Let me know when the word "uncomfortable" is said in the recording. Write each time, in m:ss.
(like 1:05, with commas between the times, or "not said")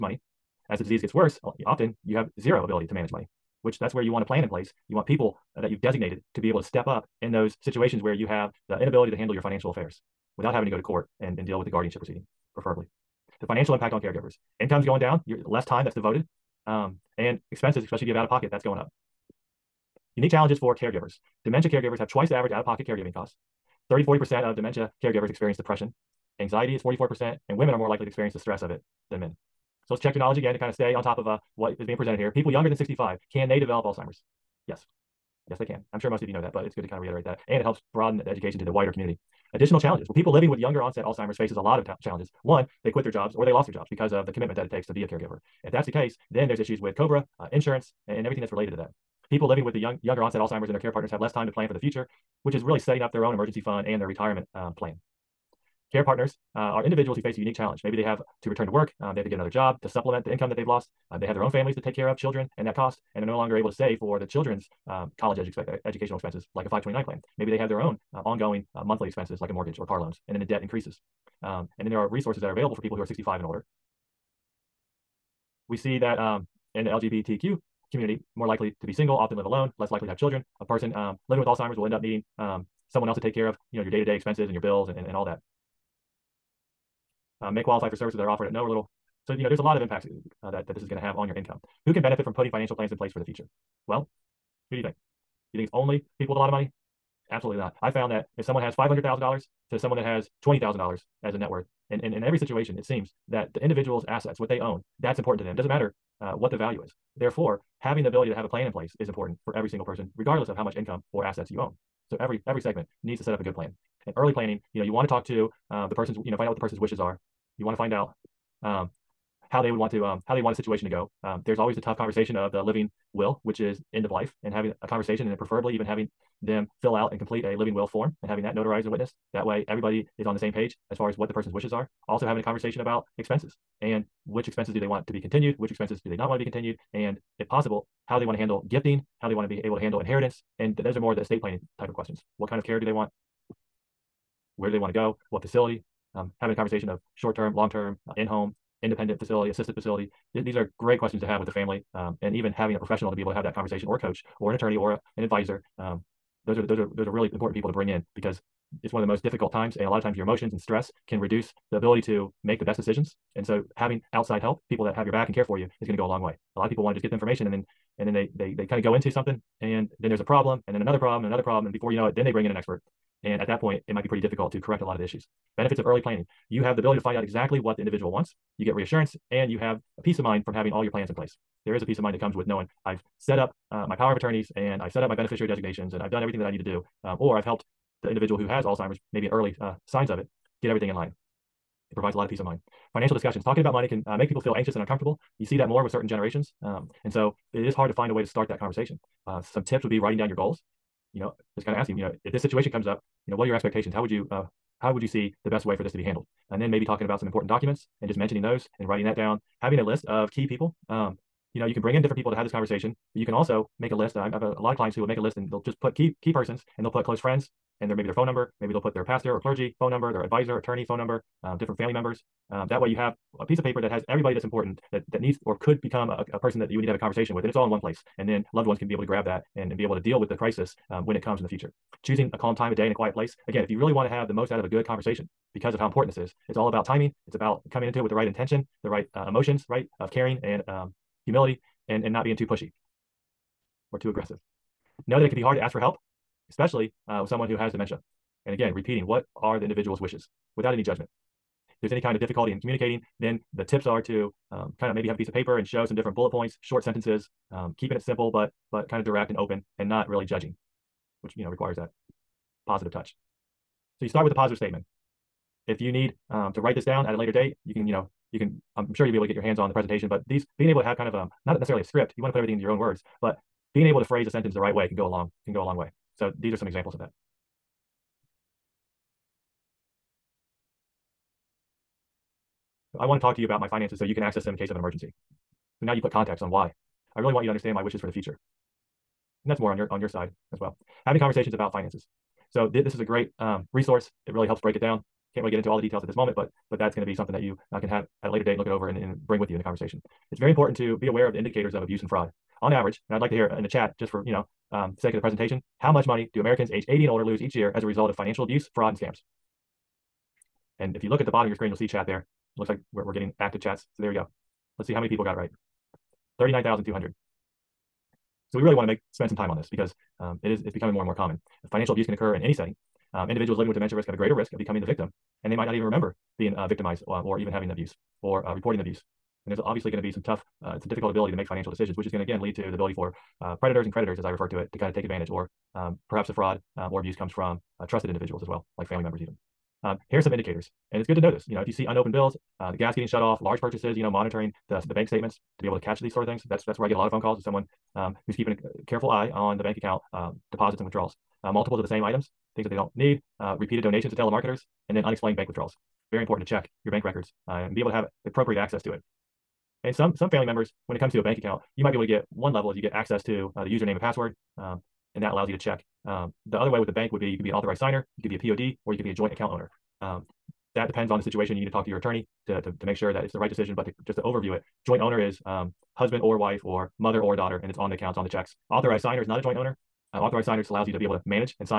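3:14.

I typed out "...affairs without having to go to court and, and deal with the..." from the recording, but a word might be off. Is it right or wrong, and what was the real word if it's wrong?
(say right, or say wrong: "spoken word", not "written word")
right.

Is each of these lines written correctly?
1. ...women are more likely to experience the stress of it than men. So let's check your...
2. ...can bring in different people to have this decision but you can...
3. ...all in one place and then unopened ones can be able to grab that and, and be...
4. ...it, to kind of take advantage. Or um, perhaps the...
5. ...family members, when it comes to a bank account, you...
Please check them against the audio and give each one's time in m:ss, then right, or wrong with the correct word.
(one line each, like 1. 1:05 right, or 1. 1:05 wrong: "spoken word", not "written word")
1. 0:27 right
2. 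3:31 wrong: "conversation", not "decision"
3. 3:47 wrong: "loved", not "unopened"
4. 5:34 right
5. 6:00 right.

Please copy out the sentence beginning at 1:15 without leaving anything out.
We see that um, in the LGBTQ community, more likely to be single, often live alone, less likely to have children.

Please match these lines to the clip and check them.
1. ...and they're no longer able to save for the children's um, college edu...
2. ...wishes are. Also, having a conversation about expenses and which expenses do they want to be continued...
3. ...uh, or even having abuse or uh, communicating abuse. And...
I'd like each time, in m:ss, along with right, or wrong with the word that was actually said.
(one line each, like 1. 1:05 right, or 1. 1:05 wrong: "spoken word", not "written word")
1. 1:03 right
2. 2:11 right
3. 5:27 wrong: "reporting", not "communicating".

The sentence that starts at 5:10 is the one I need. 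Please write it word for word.
And if you look at the bottom of your screen, you'll see chat there.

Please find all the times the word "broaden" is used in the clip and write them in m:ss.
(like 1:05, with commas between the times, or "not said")
0:37.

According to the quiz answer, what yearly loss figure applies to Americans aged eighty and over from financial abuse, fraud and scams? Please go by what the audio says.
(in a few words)
39,200.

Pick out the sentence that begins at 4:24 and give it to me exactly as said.
So you start with the positive statement.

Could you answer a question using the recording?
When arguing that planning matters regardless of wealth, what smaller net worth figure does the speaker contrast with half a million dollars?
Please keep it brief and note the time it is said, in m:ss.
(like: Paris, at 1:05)
$20,000, at 1:40.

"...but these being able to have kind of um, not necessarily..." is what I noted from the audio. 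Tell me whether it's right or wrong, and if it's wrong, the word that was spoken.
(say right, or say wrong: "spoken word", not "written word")
right.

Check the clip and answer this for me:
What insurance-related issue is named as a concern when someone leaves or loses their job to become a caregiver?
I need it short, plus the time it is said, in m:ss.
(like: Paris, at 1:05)
COBRA, at 0:46.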